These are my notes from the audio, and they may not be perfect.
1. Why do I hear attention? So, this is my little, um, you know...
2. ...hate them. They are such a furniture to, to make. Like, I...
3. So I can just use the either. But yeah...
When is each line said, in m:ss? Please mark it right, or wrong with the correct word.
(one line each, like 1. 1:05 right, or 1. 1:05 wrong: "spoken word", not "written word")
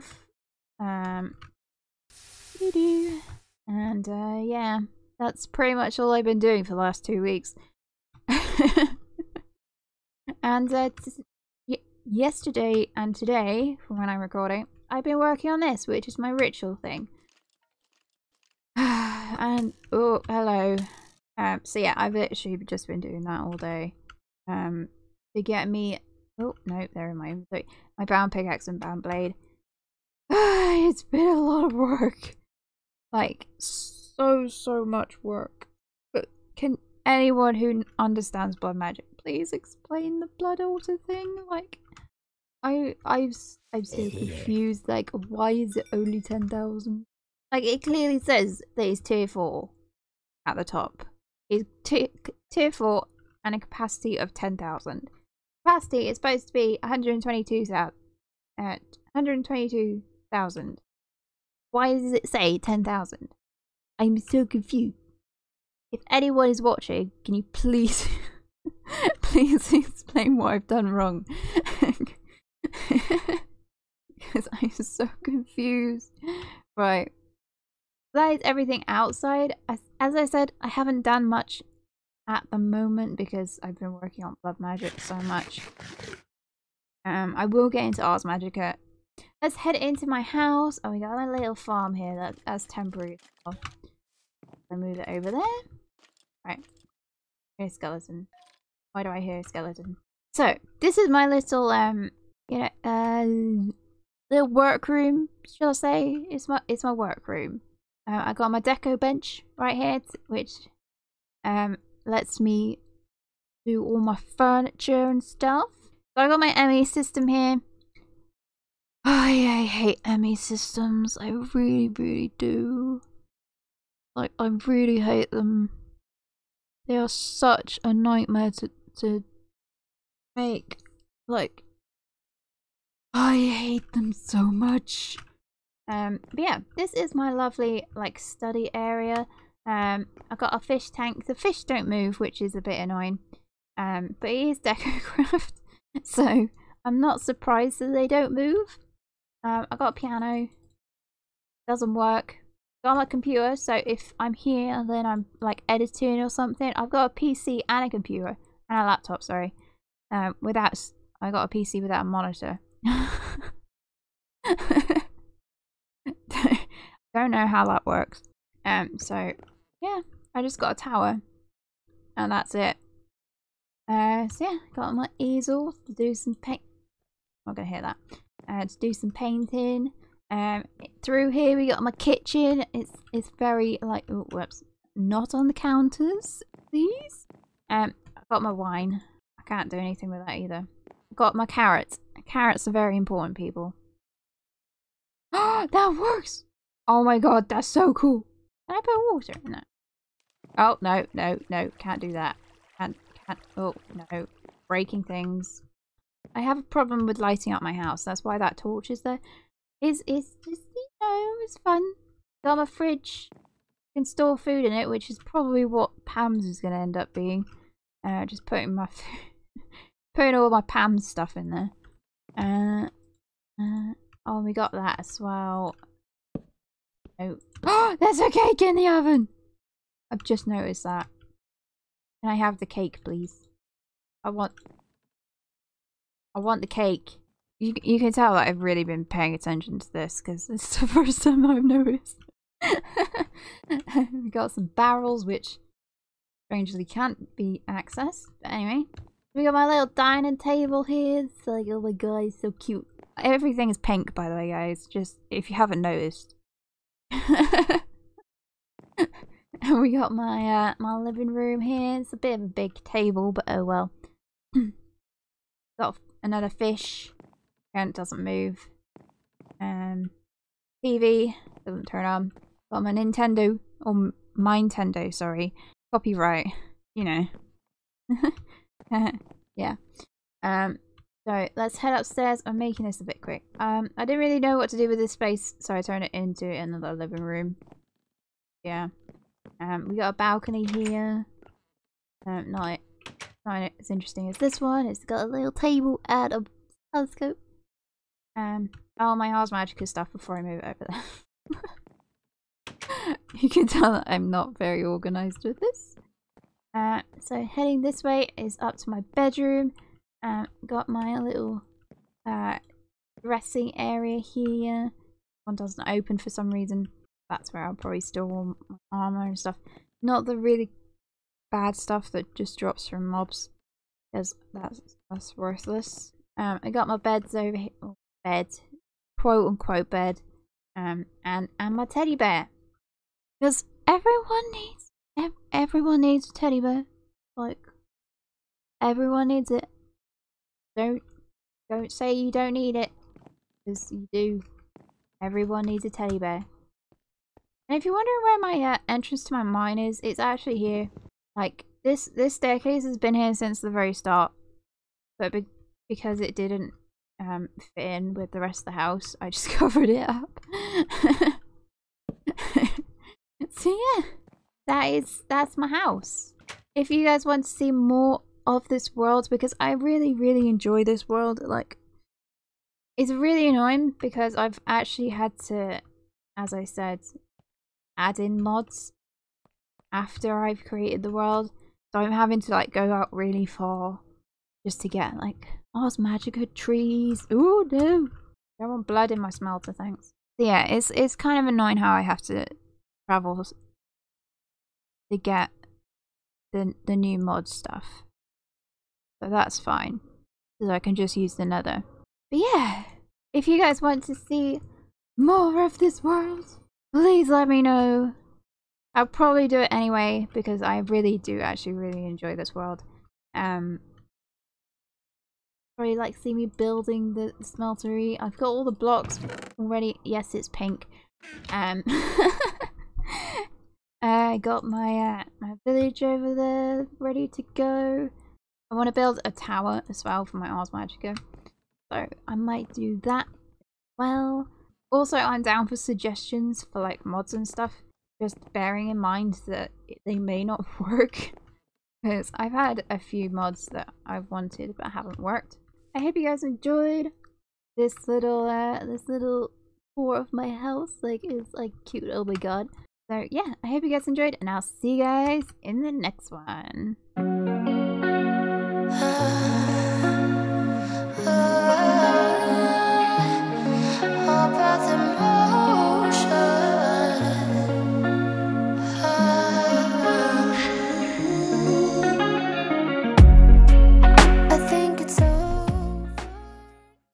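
1. 1:38 wrong: "skeleton", not "attention"
2. 2:05 wrong: "nightmare", not "furniture"
3. 6:40 wrong: "nether", not "either".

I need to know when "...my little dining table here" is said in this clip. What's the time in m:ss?
4:09.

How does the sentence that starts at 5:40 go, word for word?
Don't don't say you don't need it.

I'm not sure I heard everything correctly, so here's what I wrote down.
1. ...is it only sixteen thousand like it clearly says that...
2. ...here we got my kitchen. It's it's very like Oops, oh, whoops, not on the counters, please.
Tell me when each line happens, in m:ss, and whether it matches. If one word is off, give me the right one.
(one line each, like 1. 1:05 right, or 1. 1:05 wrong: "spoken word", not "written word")
1. 0:45 wrong: "ten", not "sixteen"
2. 3:01 right.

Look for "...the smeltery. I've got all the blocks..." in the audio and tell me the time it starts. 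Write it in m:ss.
6:57.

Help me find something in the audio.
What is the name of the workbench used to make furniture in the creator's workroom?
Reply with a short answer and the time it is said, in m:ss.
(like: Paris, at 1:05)
deco bench, at 1:48.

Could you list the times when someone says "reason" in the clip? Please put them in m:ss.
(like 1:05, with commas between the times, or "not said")
5:16.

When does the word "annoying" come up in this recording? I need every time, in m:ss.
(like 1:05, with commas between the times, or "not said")
2:22, 6:13, 6:31.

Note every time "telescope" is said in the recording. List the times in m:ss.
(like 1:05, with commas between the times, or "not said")
4:56.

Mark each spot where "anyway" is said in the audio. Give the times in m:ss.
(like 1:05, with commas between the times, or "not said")
4:08, 6:49.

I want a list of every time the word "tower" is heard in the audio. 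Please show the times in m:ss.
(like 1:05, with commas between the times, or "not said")
2:50, 7:09.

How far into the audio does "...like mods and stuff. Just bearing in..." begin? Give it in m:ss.
7:16.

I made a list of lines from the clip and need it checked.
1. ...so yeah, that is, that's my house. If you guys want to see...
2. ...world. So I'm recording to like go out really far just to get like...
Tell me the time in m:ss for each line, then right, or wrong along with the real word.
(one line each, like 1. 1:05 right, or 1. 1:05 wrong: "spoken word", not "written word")
1. 6:03 right
2. 6:21 wrong: "having", not "recording".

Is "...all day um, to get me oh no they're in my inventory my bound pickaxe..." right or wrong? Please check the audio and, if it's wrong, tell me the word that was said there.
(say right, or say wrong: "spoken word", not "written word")
right.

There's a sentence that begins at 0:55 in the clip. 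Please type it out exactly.
Capacity is supposed to be 122,000.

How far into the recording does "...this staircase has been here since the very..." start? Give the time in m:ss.
5:52.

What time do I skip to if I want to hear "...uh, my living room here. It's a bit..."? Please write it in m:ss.
4:20.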